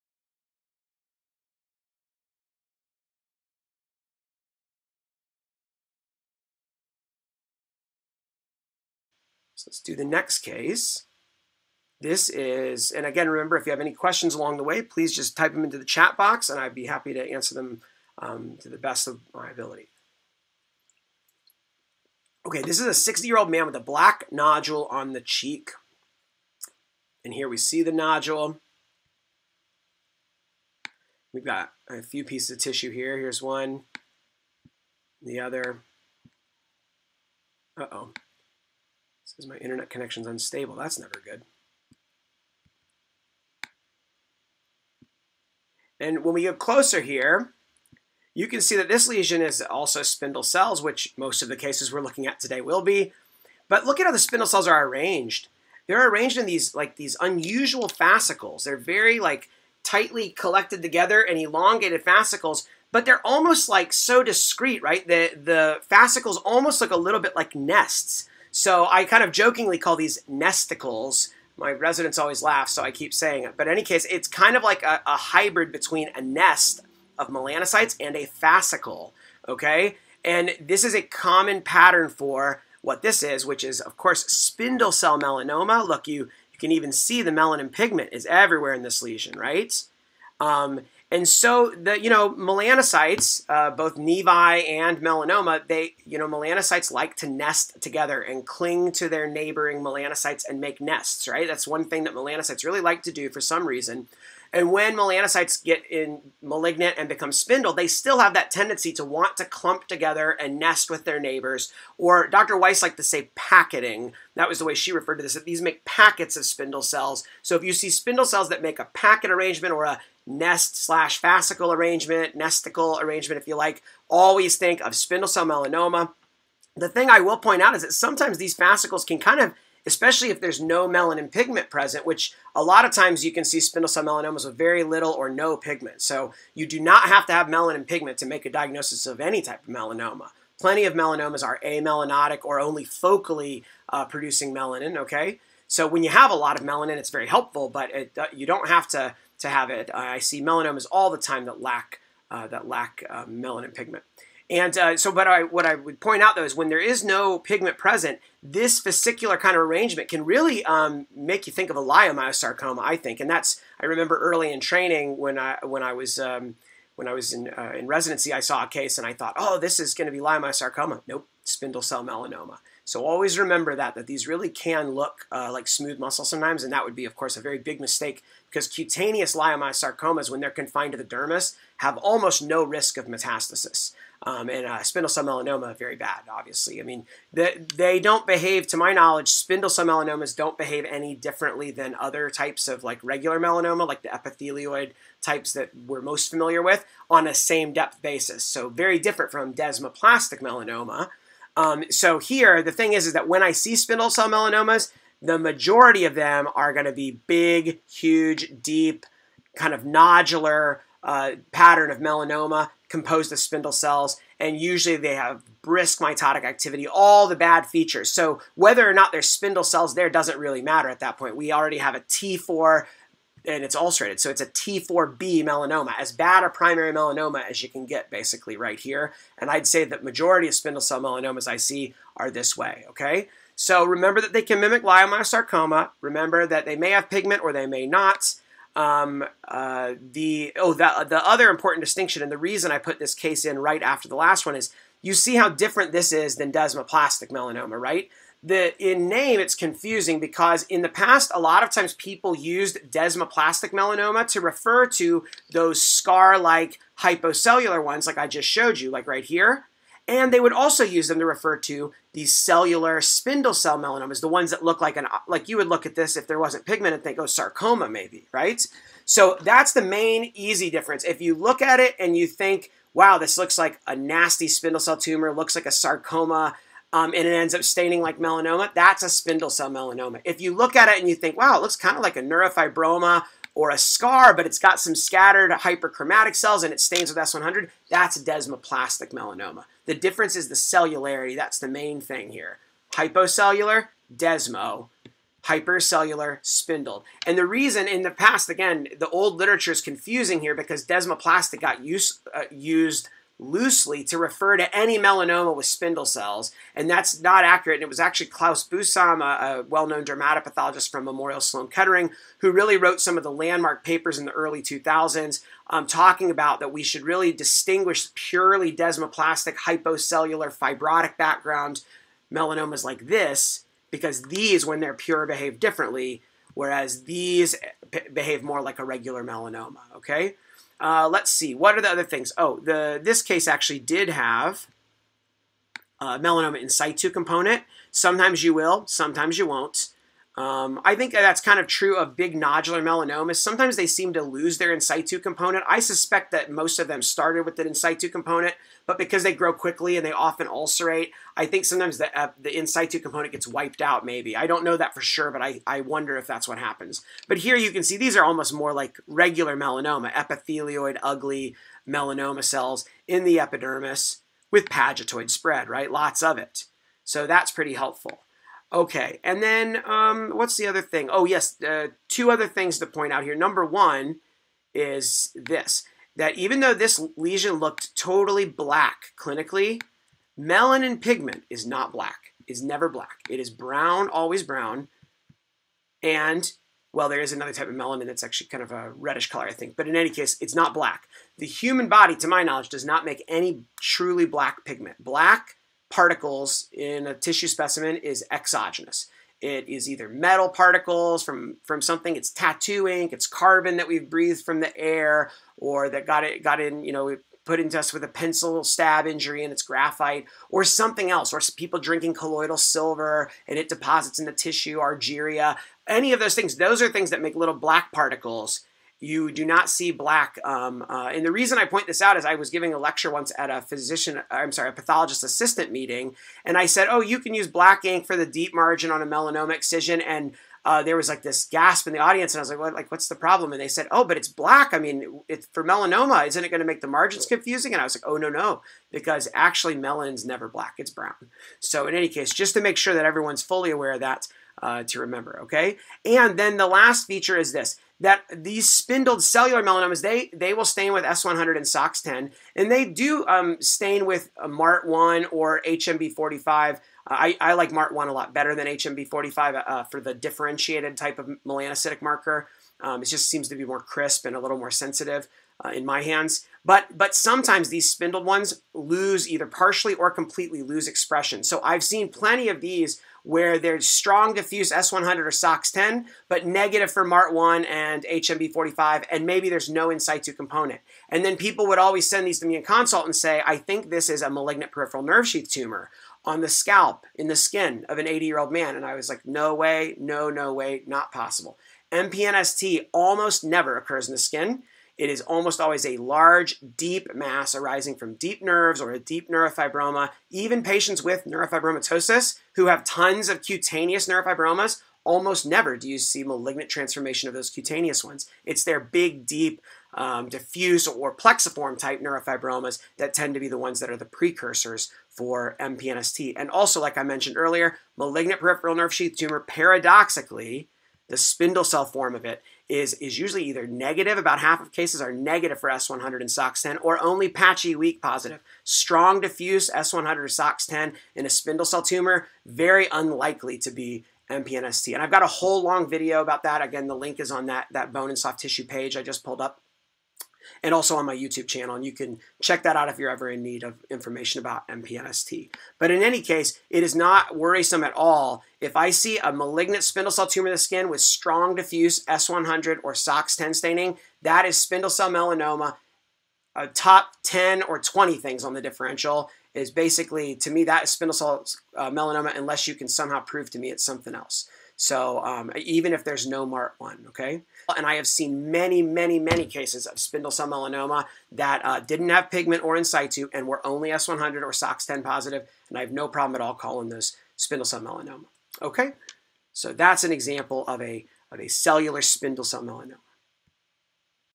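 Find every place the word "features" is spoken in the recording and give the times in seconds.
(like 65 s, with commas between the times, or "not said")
217 s, 447 s.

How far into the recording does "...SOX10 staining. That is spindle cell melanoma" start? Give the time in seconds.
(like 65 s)
552 s.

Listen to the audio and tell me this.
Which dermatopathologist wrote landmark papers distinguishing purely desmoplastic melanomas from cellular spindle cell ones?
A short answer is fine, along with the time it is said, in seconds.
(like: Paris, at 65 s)
Klaus Busam, at 308 s.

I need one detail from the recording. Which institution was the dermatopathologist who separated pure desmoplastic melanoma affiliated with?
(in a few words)
Memorial Sloan Kettering.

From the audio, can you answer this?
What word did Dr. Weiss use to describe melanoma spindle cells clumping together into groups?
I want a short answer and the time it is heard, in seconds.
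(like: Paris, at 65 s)
packeting, at 113 s.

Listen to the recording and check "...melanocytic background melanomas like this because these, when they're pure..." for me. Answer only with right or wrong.
wrong.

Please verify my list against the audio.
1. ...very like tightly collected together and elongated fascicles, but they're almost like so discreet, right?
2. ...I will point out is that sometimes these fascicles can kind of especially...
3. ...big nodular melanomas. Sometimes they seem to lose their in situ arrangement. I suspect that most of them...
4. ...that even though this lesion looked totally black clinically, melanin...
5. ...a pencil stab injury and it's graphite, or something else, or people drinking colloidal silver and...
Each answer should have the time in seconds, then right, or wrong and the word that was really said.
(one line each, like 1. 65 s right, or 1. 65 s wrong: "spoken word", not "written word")
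1. 58 s right
2. 127 s right
3. 342 s wrong: "component", not "arrangement"
4. 376 s right
5. 408 s right.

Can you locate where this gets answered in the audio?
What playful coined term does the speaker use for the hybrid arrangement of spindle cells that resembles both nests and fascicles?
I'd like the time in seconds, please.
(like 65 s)
70 s.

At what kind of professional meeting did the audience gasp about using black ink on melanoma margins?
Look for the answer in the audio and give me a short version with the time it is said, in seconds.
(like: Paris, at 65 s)
pathologist assistant meeting, at 424 s.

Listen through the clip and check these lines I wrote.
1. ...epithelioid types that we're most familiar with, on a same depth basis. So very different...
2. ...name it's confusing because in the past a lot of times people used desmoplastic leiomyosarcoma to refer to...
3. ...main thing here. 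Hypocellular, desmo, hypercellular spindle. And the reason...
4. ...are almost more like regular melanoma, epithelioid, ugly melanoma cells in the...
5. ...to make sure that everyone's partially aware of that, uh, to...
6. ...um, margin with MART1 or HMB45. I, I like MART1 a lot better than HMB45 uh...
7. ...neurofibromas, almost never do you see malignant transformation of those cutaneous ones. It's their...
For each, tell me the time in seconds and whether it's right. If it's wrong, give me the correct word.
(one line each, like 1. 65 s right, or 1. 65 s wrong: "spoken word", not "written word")
1. 194 s right
2. 249 s wrong: "melanoma", not "leiomyosarcoma"
3. 291 s right
4. 358 s right
5. 442 s wrong: "fully", not "partially"
6. 453 s wrong: "stain", not "margin"
7. 504 s right.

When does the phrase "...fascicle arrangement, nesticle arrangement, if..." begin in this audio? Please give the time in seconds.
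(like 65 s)
121 s.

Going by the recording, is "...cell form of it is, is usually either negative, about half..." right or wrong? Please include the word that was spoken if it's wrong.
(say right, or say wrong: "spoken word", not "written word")
right.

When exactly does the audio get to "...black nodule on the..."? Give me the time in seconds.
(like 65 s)
23 s.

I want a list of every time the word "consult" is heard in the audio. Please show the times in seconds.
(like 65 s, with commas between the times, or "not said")
482 s.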